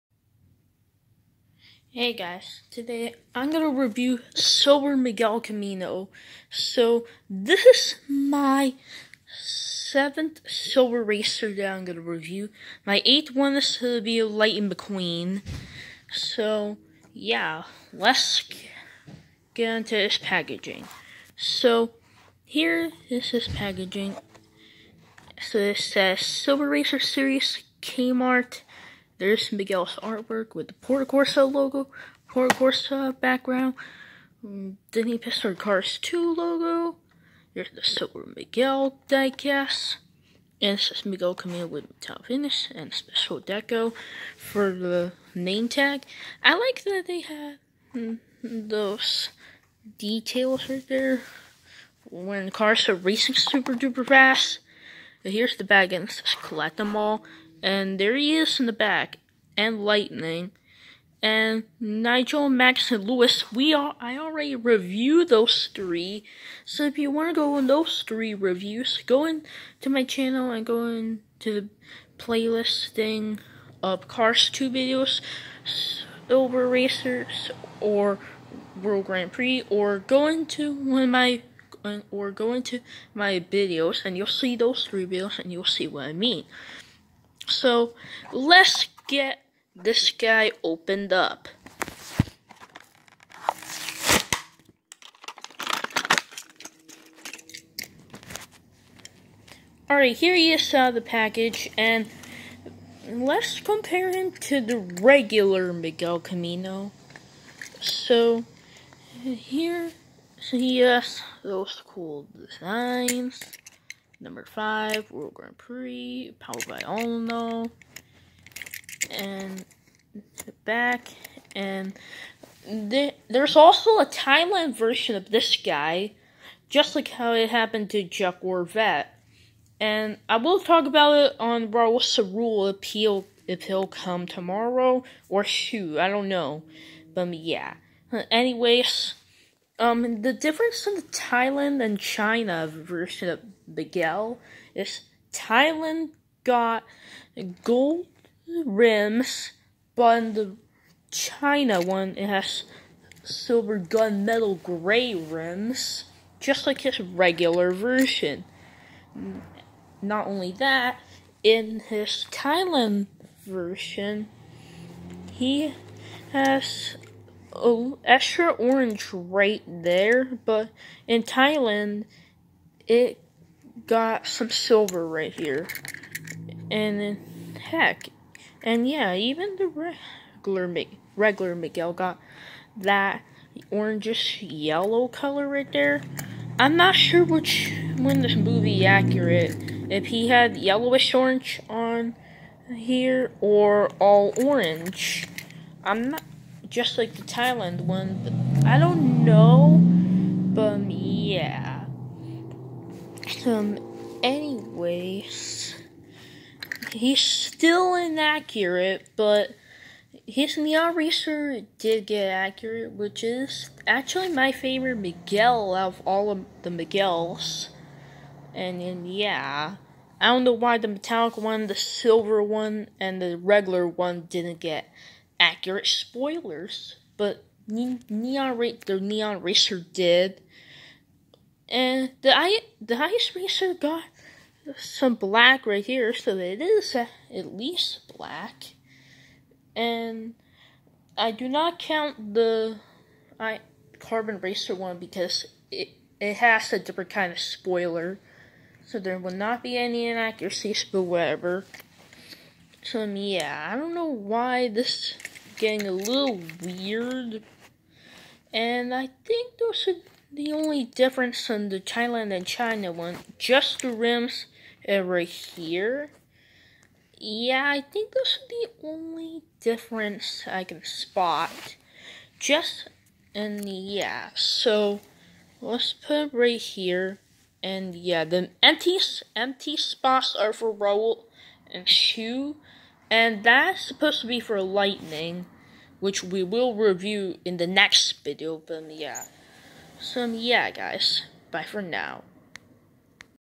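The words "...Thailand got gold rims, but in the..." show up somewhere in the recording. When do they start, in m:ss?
2:25.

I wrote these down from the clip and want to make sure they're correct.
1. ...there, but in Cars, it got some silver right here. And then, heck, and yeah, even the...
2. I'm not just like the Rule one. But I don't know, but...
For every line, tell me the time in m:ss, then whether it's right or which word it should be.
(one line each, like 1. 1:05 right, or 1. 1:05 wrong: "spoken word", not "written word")
1. 2:49 wrong: "Thailand", not "Cars"
2. 3:15 wrong: "Thailand", not "Rule".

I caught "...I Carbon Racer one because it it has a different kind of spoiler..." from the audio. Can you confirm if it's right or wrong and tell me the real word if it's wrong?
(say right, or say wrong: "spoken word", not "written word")
right.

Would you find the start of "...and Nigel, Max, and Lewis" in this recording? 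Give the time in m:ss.
1:01.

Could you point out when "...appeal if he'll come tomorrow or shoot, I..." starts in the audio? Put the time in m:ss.
2:12.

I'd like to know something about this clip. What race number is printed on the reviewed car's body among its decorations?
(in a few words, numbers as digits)
5.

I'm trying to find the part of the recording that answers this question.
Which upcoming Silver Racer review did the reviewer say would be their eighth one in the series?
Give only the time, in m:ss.
0:14.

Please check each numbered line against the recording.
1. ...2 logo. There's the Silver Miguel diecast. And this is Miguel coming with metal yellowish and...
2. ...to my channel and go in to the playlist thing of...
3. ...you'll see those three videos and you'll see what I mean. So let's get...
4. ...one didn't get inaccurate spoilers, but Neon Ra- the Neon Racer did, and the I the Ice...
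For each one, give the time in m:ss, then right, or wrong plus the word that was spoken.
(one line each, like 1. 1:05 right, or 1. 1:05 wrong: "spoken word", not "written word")
1. 0:36 wrong: "finish", not "yellowish"
2. 1:09 right
3. 1:24 right
4. 3:43 wrong: "accurate", not "inaccurate".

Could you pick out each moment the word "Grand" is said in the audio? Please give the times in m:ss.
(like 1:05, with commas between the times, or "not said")
1:19, 1:55.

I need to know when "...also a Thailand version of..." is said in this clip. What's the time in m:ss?
2:03.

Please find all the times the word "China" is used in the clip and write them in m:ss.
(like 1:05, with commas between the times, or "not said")
2:21, 2:31, 4:22.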